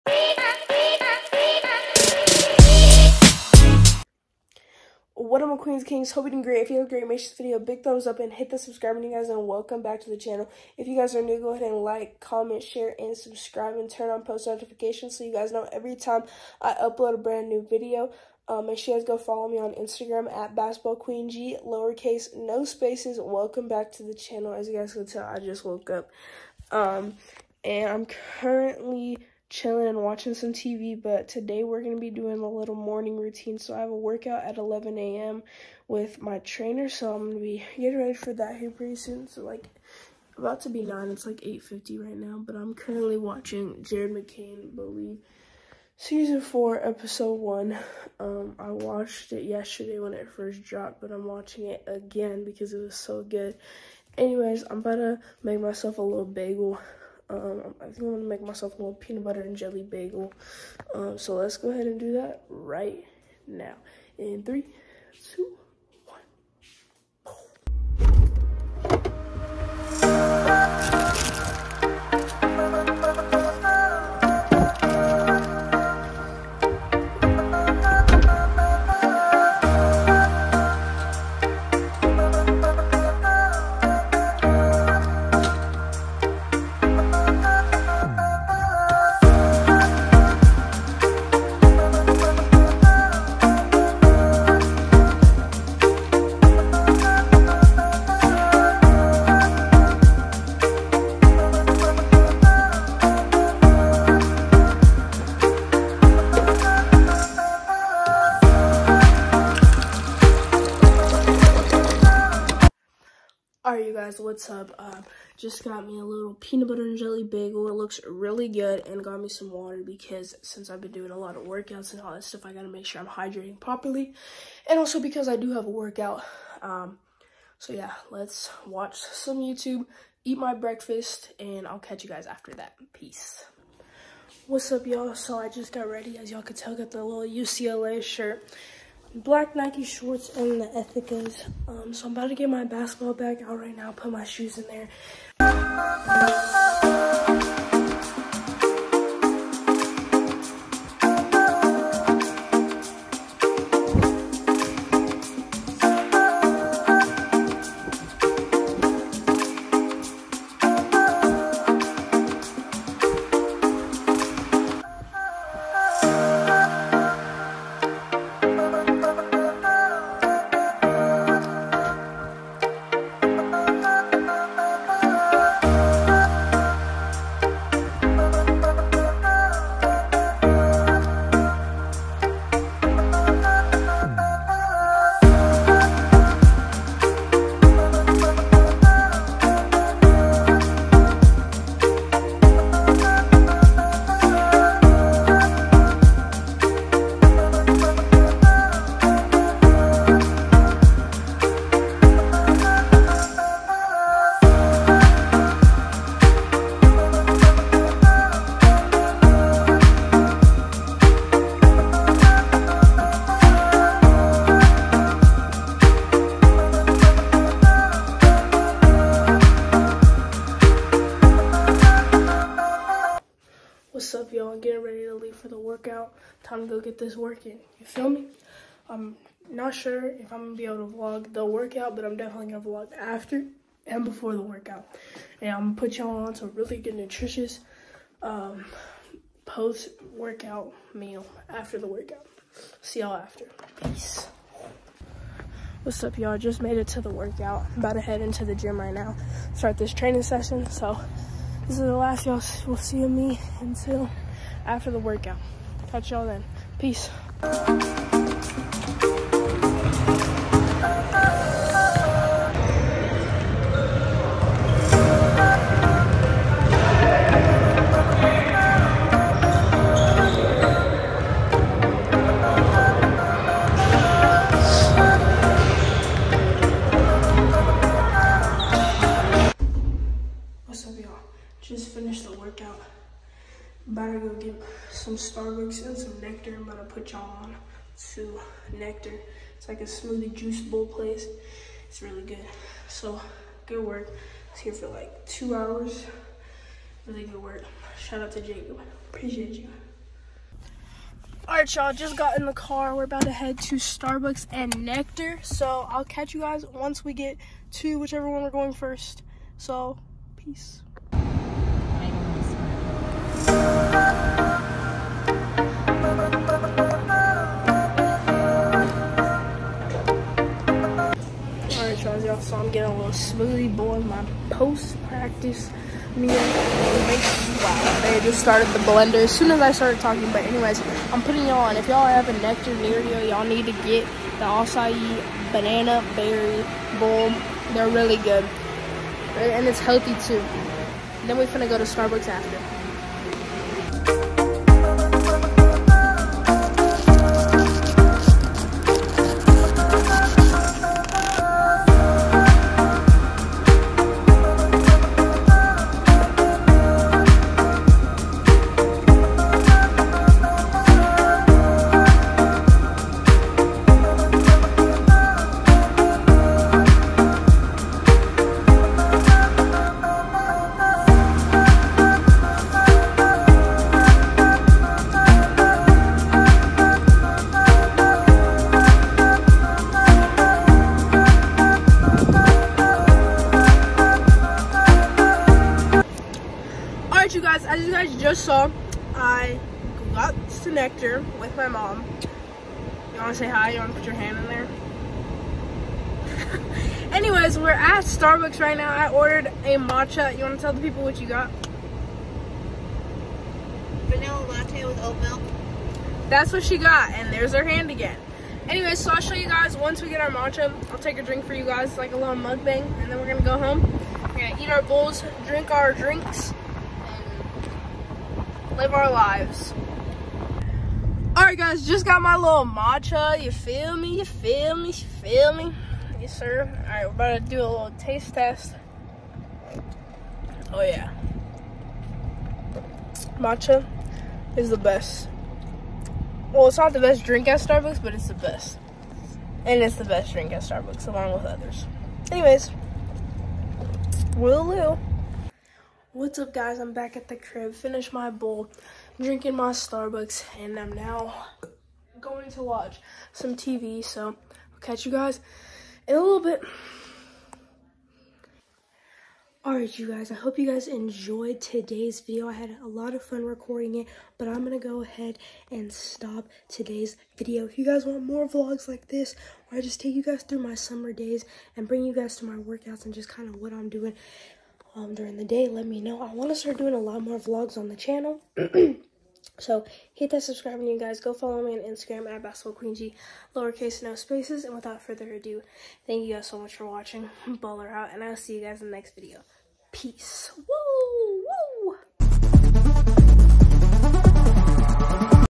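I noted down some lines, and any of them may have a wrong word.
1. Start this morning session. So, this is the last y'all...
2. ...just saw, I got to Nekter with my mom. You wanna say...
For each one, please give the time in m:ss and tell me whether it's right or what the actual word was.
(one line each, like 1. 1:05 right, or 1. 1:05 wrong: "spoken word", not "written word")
1. 4:09 wrong: "training", not "morning"
2. 6:28 right.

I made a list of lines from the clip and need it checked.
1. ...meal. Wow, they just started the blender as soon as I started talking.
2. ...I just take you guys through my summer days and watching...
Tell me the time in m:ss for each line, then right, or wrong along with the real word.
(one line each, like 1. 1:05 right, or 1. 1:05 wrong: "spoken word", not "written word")
1. 5:26 right
2. 7:49 wrong: "bring", not "watching".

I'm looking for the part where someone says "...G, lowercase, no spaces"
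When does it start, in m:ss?
0:21.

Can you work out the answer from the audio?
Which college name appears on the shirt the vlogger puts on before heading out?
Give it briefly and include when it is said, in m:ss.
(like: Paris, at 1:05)
UCLA, at 2:17.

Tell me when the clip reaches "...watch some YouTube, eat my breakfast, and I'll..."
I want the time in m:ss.
2:08.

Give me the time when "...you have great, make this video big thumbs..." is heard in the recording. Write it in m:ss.
0:06.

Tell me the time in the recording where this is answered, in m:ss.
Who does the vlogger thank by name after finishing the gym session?
4:58.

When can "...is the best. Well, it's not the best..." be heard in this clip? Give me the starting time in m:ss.
7:14.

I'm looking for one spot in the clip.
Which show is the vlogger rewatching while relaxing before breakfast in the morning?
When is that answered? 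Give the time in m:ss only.
0:43.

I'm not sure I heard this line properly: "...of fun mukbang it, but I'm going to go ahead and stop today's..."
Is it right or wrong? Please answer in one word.
wrong.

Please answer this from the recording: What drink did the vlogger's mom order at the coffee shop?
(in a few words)
Vanilla latte with oat milk.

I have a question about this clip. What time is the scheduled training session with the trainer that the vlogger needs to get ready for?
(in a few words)
11 a.m.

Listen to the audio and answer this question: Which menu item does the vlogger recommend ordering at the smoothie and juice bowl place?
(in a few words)
Acai banana berry bowl.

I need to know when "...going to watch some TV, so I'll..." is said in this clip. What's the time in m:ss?
7:32.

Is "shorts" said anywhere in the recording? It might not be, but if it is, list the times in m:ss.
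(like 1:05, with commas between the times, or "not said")
2:19.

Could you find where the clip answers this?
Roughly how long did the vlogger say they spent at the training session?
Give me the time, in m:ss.
4:55.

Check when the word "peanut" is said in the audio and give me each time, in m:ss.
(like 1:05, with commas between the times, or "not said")
0:58, 1:56.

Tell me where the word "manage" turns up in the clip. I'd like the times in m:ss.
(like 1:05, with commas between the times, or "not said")
not said.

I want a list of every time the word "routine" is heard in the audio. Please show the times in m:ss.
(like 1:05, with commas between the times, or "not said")
0:33.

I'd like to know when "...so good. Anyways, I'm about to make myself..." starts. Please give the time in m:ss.
0:52.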